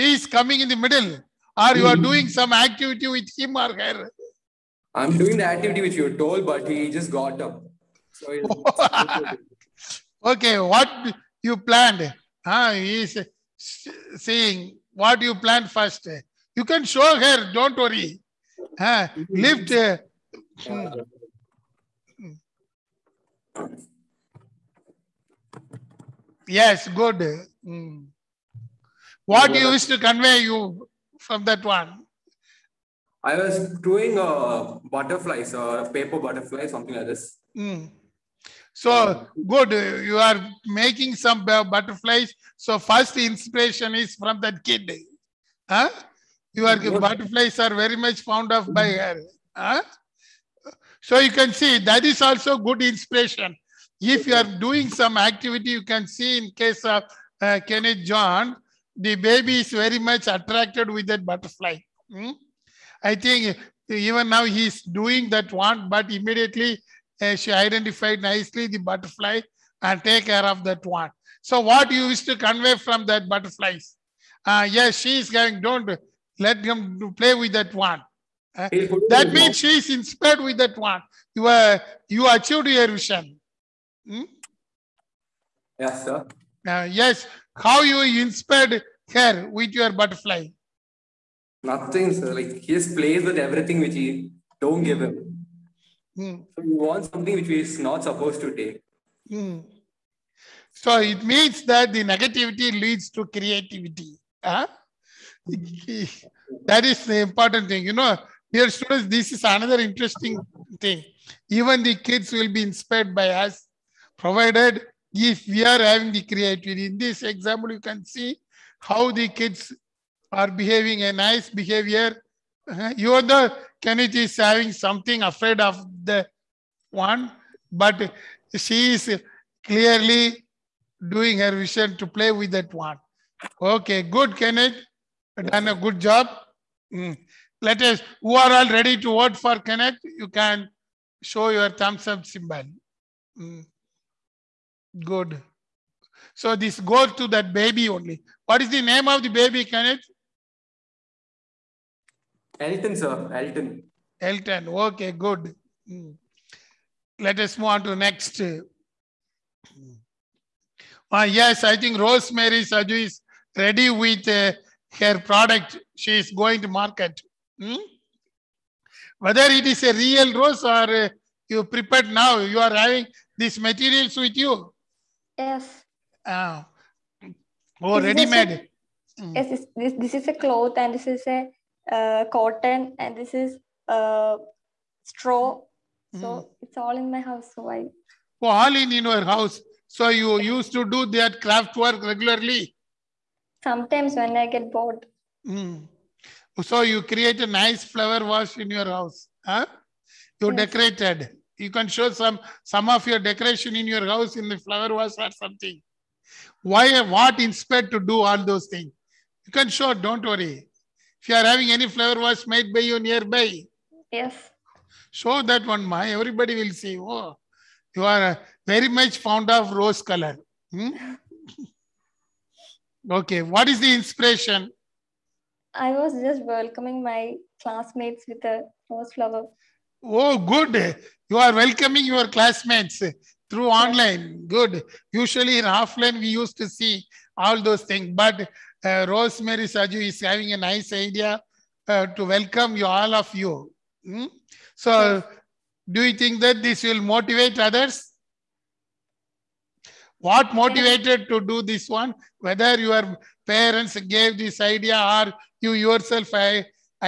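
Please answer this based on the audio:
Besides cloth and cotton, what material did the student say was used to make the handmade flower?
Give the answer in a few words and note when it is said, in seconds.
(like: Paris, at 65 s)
Straw, at 185 s.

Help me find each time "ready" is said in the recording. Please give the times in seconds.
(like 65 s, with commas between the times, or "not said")
138 s, 163 s, 178 s.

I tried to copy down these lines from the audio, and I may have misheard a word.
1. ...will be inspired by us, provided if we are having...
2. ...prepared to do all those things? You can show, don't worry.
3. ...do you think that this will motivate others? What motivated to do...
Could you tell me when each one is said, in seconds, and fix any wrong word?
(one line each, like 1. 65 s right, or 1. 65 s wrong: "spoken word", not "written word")
1. 112 s right
2. 207 s wrong: "inspired", not "prepared"
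3. 245 s right.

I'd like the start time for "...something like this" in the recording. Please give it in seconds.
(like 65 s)
36 s.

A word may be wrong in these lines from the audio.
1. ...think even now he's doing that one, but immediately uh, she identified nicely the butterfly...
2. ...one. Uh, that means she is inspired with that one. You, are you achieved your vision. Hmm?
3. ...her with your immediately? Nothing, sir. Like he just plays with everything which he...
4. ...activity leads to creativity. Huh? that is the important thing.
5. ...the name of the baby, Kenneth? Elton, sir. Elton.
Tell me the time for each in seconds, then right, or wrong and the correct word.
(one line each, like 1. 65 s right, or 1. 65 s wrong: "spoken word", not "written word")
1. 63 s right
2. 77 s right
3. 89 s wrong: "butterfly", not "immediately"
4. 102 s wrong: "negativity", not "activity"
5. 148 s right.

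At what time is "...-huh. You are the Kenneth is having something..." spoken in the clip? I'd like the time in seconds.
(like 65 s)
122 s.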